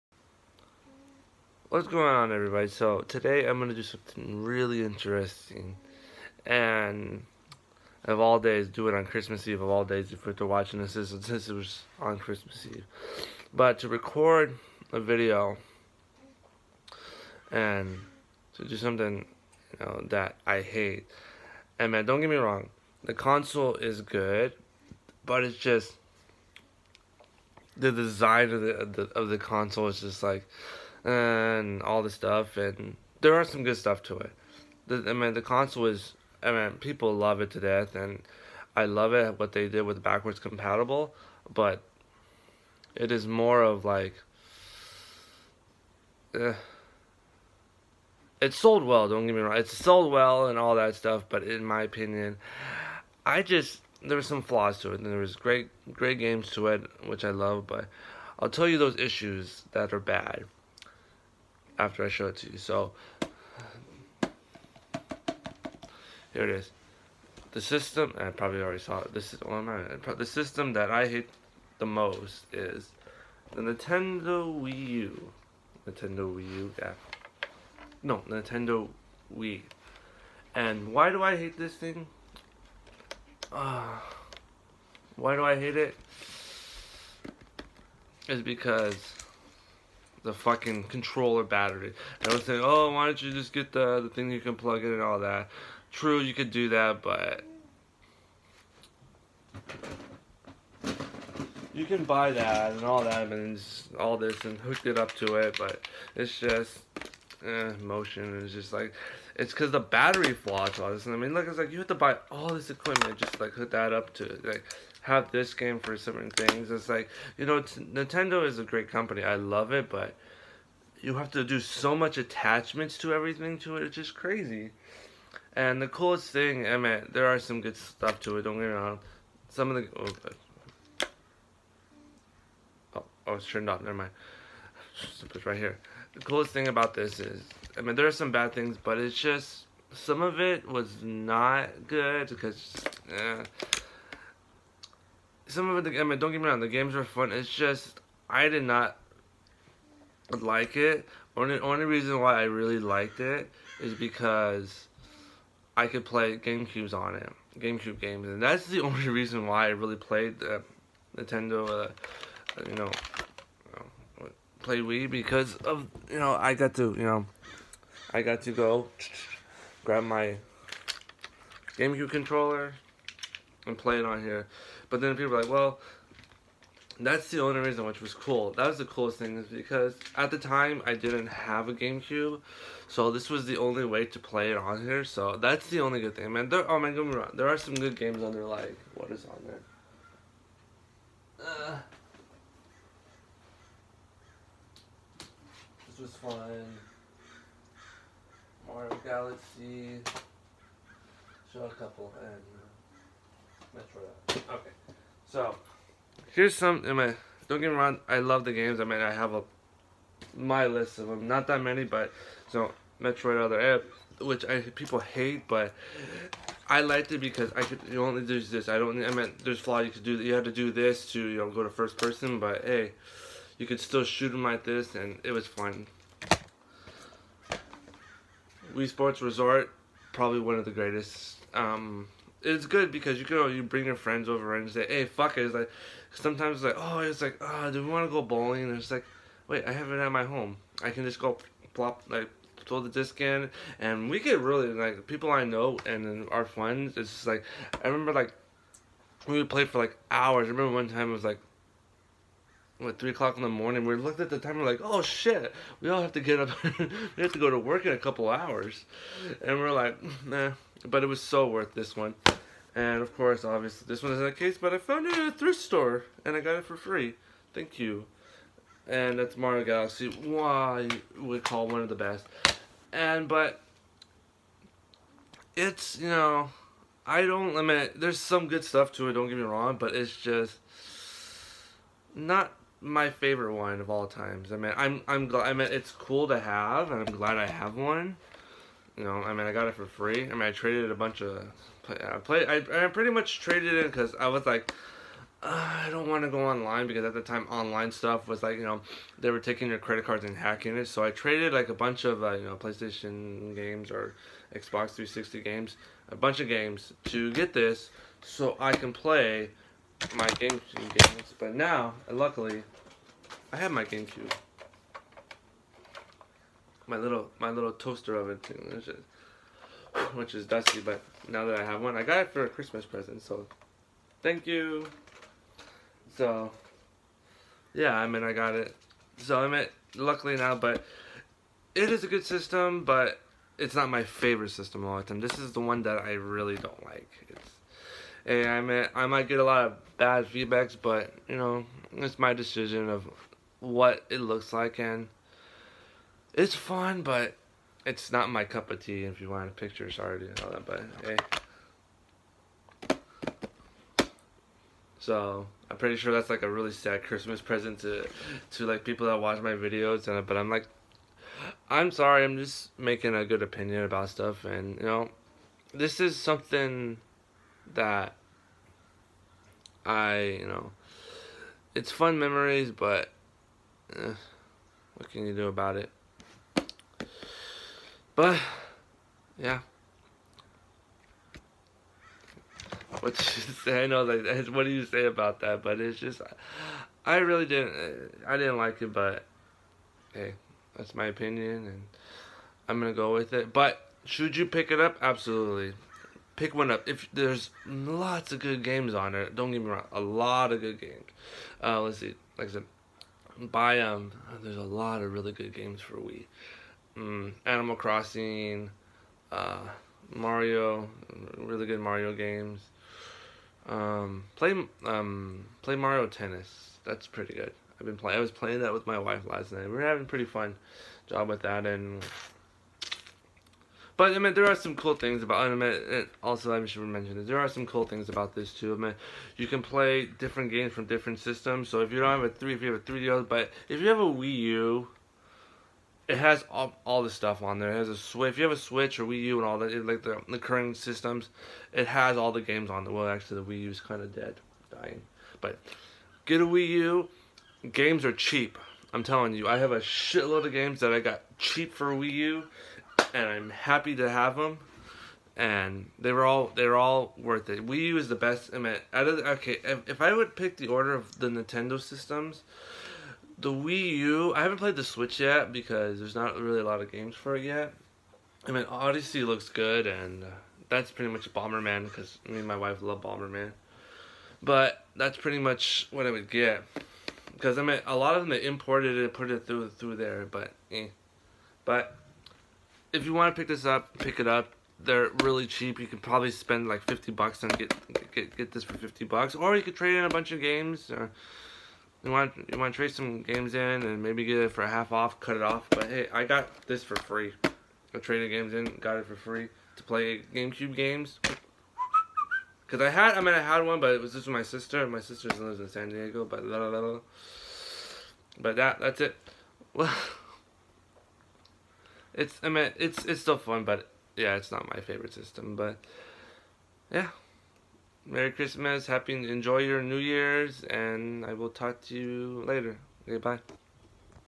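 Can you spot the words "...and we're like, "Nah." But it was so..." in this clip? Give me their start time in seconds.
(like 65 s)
259 s.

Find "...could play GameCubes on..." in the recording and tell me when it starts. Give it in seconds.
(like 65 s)
155 s.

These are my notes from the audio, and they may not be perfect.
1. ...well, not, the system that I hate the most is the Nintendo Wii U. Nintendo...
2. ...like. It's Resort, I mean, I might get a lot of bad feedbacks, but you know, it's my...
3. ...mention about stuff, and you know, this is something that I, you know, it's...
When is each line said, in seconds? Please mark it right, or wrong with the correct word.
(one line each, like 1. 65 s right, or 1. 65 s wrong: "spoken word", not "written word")
1. 69 s right
2. 336 s wrong: "Hey", not "Resort"
3. 363 s wrong: "opinion", not "mention".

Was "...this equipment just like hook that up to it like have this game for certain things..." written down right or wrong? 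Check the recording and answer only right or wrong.
right.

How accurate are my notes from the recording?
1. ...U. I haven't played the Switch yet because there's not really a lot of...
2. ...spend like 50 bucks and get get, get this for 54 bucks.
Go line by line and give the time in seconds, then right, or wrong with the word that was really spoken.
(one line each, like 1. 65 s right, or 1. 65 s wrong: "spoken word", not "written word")
1. 463 s right
2. 486 s wrong: "50", not "54".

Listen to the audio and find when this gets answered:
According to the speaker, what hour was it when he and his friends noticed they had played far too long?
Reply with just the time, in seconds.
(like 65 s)
252 s.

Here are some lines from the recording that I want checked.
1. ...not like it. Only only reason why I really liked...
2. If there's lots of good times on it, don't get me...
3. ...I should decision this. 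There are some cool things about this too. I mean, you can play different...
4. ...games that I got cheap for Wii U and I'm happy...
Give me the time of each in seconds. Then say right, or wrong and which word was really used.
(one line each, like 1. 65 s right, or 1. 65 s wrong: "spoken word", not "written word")
1. 148 s right
2. 396 s wrong: "games", not "times"
3. 426 s wrong: "mention", not "decision"
4. 450 s right.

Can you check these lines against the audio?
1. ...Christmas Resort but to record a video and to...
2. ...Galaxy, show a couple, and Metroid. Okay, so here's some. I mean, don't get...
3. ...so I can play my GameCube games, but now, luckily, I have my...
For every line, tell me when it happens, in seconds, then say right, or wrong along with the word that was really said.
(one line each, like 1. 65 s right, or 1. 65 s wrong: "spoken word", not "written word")
1. 12 s wrong: "Eve", not "Resort"
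2. 199 s right
3. 308 s right.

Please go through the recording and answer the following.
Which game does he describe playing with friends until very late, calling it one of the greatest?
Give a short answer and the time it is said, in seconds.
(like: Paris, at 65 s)
Wii Sports Resort, at 228 s.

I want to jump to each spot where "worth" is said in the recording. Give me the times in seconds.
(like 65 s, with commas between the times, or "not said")
261 s, 457 s.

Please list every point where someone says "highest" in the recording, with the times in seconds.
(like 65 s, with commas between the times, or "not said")
not said.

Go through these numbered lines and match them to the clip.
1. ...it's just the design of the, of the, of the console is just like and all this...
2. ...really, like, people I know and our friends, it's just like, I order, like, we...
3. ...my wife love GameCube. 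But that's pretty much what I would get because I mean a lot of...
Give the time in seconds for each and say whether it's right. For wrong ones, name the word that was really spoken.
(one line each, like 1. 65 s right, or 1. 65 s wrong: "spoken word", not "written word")
1. 25 s right
2. 244 s wrong: "remember", not "order"
3. 472 s wrong: "Bomberman", not "GameCube".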